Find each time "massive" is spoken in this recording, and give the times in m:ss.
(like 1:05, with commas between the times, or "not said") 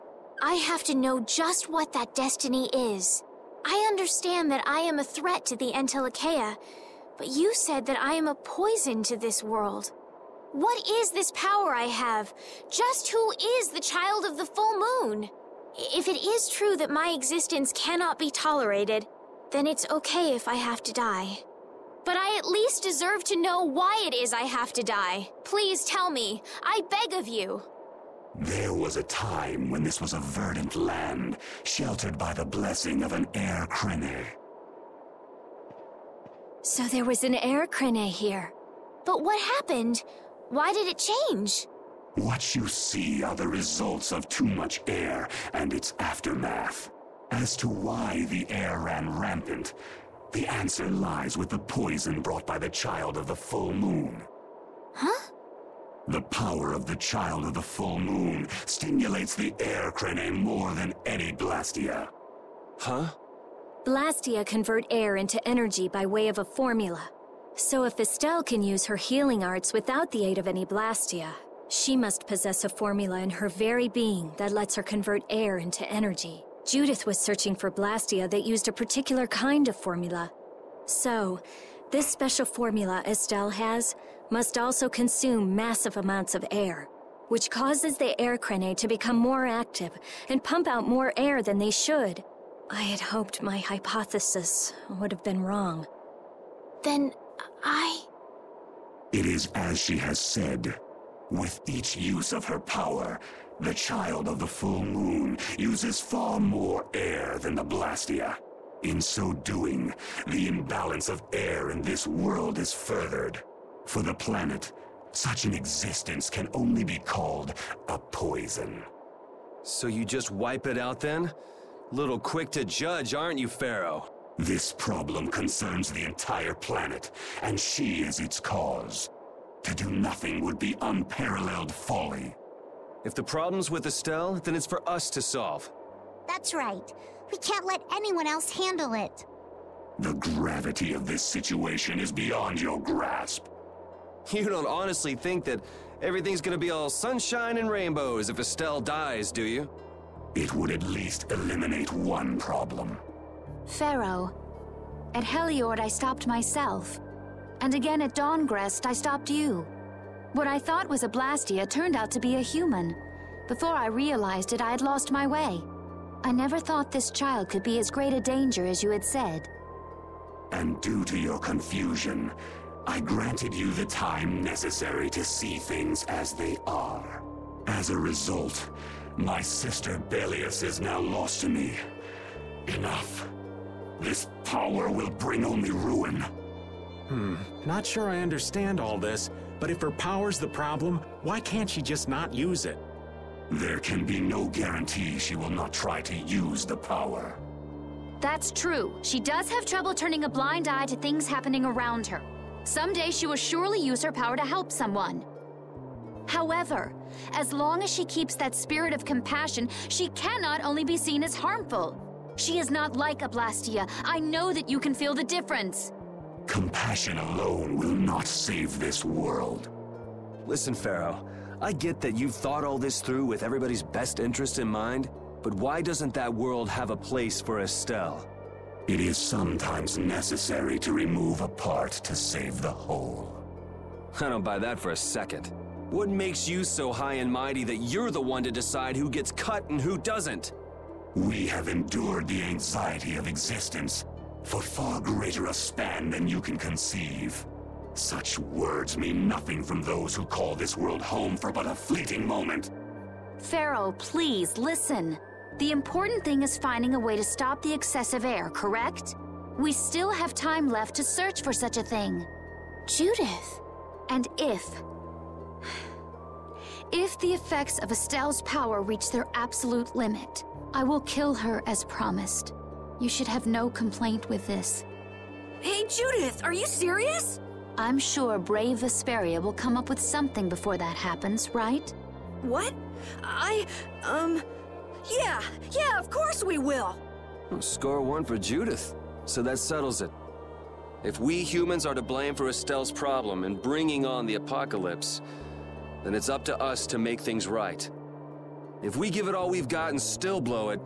1:25.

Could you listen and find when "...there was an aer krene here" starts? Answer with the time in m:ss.
0:36.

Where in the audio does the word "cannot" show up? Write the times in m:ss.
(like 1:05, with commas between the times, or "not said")
0:17, 3:30.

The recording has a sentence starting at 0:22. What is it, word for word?
But I at least deserve to know why it is I have to die.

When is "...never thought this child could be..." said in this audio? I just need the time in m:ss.
2:46.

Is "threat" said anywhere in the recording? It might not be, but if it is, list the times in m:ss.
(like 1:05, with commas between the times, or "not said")
0:05.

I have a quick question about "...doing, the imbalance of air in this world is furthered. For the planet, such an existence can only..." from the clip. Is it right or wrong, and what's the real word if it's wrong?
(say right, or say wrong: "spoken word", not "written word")
right.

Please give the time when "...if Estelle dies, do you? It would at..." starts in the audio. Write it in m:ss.
2:28.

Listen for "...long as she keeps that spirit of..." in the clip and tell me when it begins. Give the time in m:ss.
3:27.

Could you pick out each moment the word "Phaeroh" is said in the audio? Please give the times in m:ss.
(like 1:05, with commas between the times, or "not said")
2:03, 2:33, 3:40, 4:13.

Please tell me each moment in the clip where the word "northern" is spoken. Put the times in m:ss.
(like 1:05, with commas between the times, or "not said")
not said.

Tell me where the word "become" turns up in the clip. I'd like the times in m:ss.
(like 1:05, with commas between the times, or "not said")
1:28.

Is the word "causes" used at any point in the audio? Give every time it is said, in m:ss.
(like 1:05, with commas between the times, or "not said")
1:27, 2:08.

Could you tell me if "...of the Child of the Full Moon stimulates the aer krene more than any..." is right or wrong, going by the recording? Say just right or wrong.
right.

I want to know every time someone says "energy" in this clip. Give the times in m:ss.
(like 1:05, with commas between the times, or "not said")
1:05, 1:15.